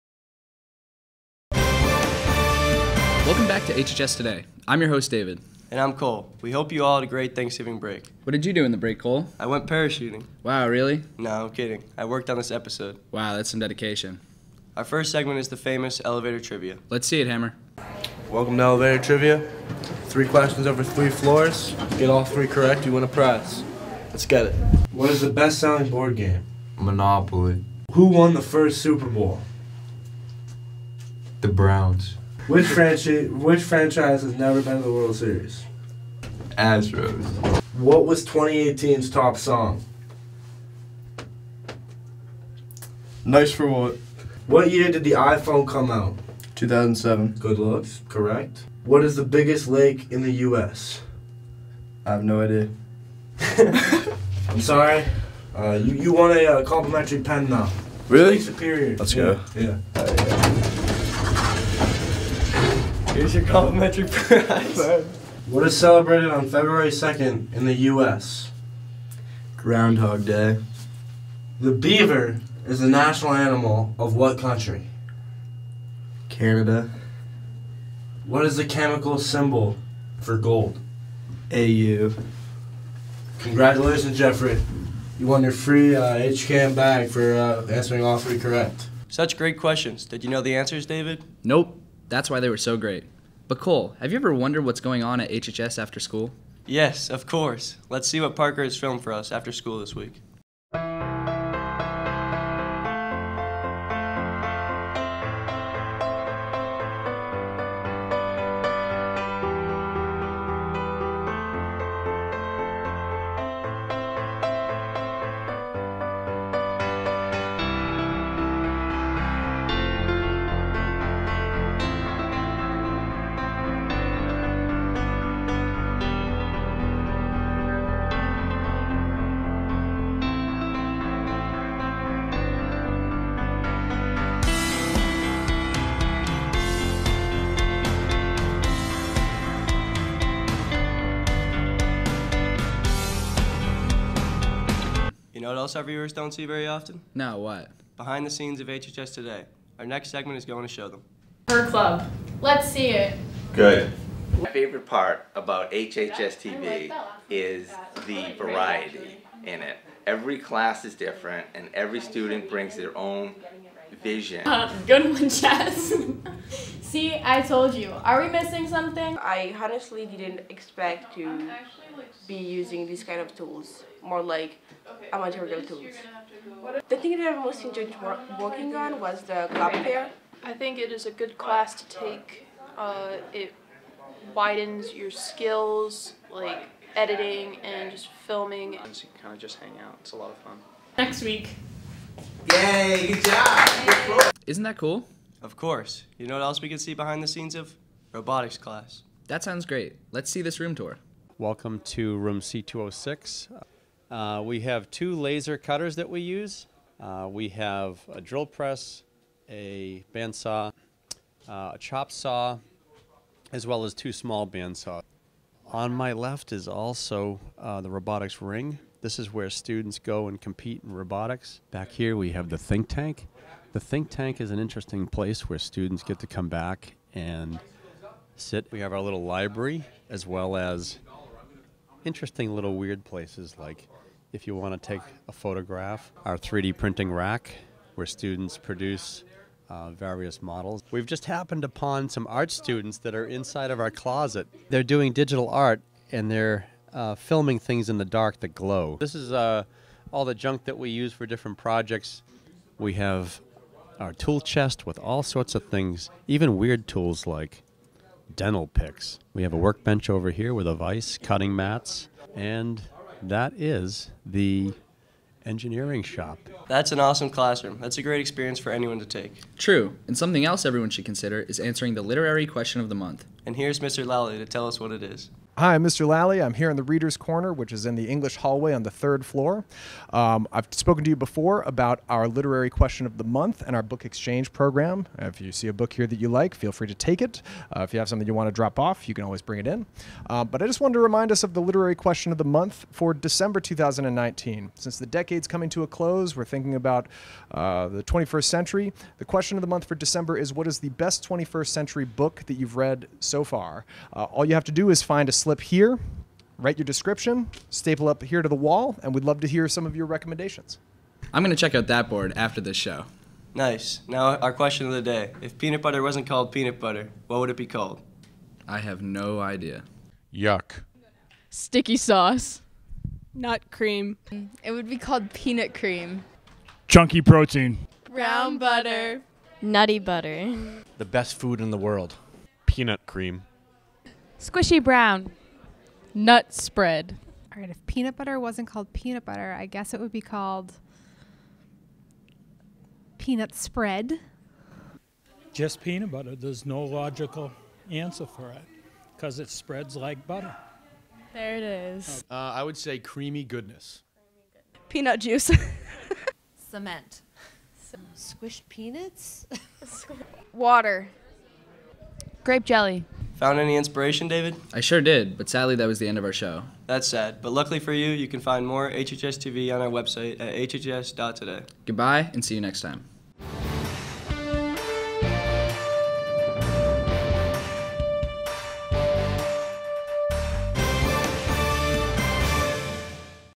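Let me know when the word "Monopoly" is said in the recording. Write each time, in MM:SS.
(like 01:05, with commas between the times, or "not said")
00:26.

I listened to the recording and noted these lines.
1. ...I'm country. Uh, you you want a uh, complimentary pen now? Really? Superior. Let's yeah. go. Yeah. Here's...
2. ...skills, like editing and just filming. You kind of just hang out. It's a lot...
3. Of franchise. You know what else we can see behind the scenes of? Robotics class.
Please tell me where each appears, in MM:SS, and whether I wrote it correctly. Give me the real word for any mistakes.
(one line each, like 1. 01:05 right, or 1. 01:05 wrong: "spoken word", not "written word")
1. 00:54 wrong: "sorry", not "country"
2. 03:05 right
3. 03:15 wrong: "course", not "franchise".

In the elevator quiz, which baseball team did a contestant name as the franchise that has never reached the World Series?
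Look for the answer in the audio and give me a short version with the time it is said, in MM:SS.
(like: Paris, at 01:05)
Astros, at 00:36.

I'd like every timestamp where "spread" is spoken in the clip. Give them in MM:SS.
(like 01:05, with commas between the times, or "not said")
05:36, 05:43, 05:49.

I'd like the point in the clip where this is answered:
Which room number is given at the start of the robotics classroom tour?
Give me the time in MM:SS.
03:22.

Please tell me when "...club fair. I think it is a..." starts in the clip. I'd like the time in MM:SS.
02:59.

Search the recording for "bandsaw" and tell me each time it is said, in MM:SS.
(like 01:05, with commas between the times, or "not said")
03:30, 03:34.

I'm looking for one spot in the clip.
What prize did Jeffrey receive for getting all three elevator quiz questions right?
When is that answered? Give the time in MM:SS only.
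01:26.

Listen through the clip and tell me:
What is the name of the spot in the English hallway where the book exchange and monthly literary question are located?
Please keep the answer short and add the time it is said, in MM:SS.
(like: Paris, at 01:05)
Reader's Corner, at 04:36.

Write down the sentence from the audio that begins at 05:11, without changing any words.
I'm going to check out that board after this show.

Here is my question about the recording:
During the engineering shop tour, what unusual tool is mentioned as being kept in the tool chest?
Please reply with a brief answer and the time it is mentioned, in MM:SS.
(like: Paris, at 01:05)
Dental picks, at 04:18.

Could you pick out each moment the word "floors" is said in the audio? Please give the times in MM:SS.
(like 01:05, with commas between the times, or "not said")
00:21, 04:39.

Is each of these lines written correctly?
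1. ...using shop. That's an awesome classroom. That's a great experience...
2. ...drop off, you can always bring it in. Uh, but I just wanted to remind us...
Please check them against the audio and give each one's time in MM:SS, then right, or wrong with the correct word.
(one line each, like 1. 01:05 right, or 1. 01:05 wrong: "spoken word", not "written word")
1. 04:25 wrong: "engineering", not "using"
2. 04:48 right.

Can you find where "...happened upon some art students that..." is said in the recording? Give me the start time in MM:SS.
04:01.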